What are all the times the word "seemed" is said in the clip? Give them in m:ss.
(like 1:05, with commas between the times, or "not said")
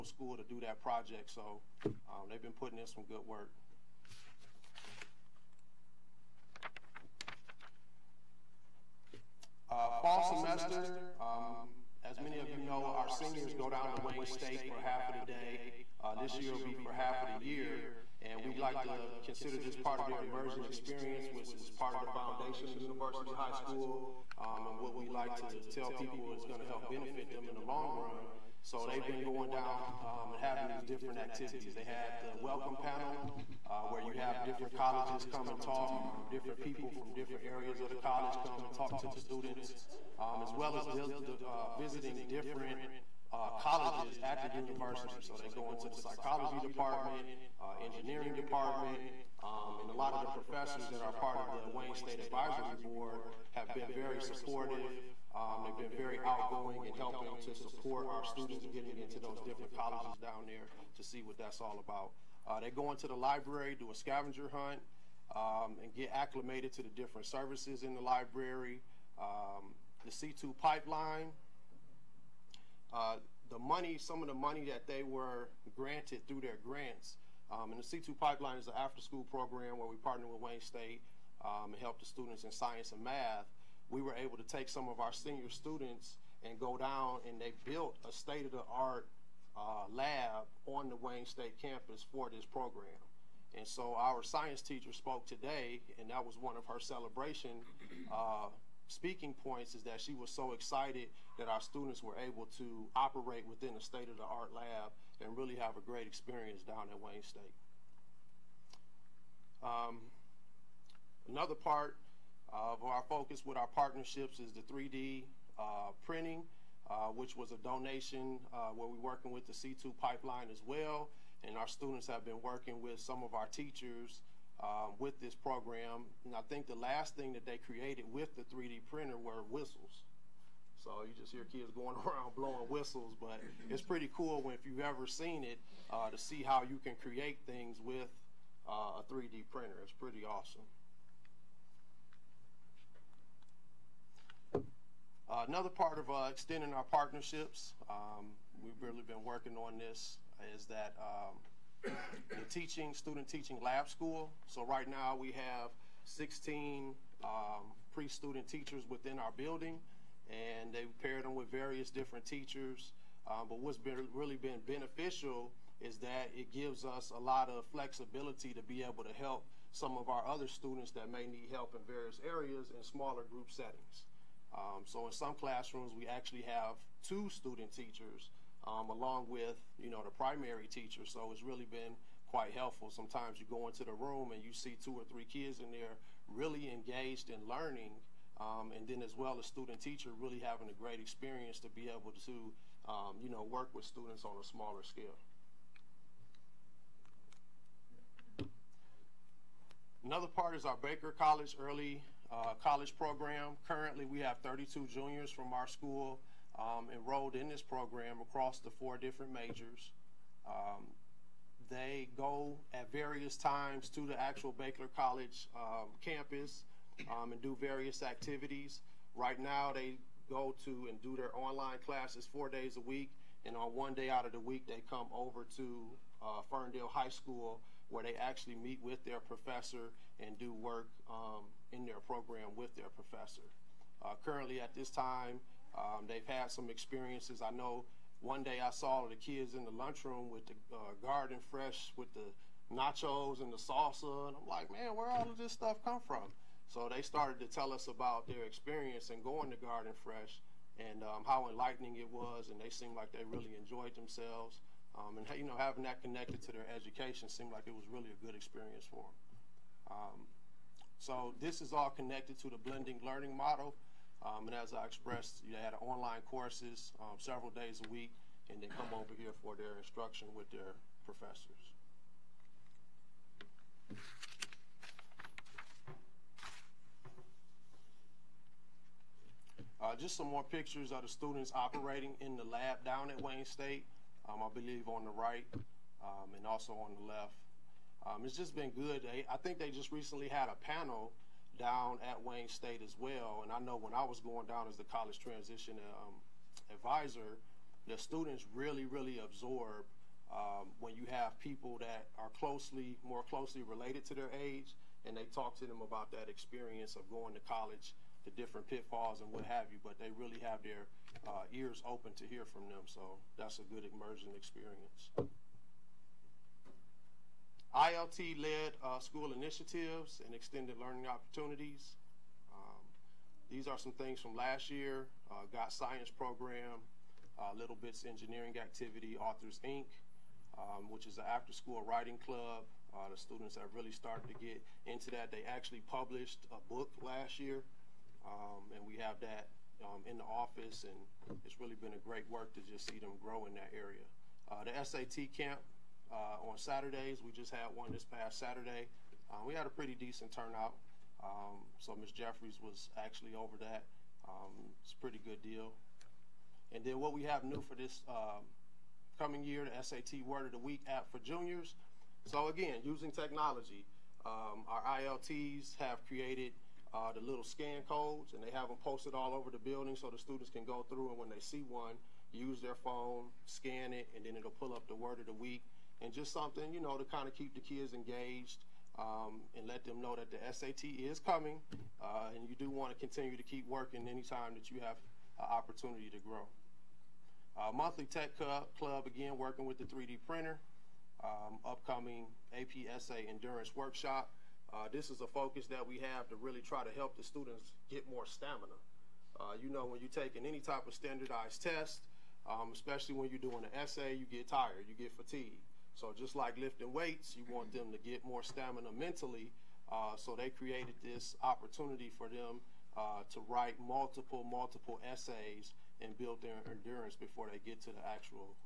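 4:12, 4:17.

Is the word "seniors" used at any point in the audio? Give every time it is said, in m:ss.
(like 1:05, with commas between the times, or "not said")
0:13, 1:25.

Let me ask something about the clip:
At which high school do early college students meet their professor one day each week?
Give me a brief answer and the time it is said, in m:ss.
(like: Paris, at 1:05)
Ferndale High School, at 3:46.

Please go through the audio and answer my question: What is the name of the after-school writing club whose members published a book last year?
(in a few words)
Authors Inc.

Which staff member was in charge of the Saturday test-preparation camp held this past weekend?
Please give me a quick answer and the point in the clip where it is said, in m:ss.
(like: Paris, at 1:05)
Ms. Jeffries, at 5:51.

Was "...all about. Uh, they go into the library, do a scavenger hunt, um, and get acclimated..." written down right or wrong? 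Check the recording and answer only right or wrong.
right.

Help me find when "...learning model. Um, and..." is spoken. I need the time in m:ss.
4:23.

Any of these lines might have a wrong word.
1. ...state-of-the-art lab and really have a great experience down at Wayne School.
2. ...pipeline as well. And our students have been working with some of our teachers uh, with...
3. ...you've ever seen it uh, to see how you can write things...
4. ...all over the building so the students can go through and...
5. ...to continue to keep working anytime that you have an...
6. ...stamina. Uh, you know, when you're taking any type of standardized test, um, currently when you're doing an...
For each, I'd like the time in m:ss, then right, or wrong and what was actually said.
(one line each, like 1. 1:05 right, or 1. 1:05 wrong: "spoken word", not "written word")
1. 1:43 wrong: "State", not "School"
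2. 2:00 right
3. 2:14 wrong: "create", not "write"
4. 6:09 right
5. 6:22 right
6. 6:38 wrong: "especially", not "currently".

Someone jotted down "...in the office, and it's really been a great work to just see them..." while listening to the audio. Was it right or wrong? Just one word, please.
right.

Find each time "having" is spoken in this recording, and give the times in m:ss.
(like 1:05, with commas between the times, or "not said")
0:30, 3:10, 4:15.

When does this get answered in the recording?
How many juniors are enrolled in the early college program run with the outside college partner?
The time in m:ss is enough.
3:24.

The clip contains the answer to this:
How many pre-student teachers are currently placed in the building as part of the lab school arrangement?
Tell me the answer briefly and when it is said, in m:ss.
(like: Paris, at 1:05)
16, at 2:36.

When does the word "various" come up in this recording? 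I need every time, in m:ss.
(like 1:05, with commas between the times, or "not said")
2:41, 2:51, 3:32, 3:37.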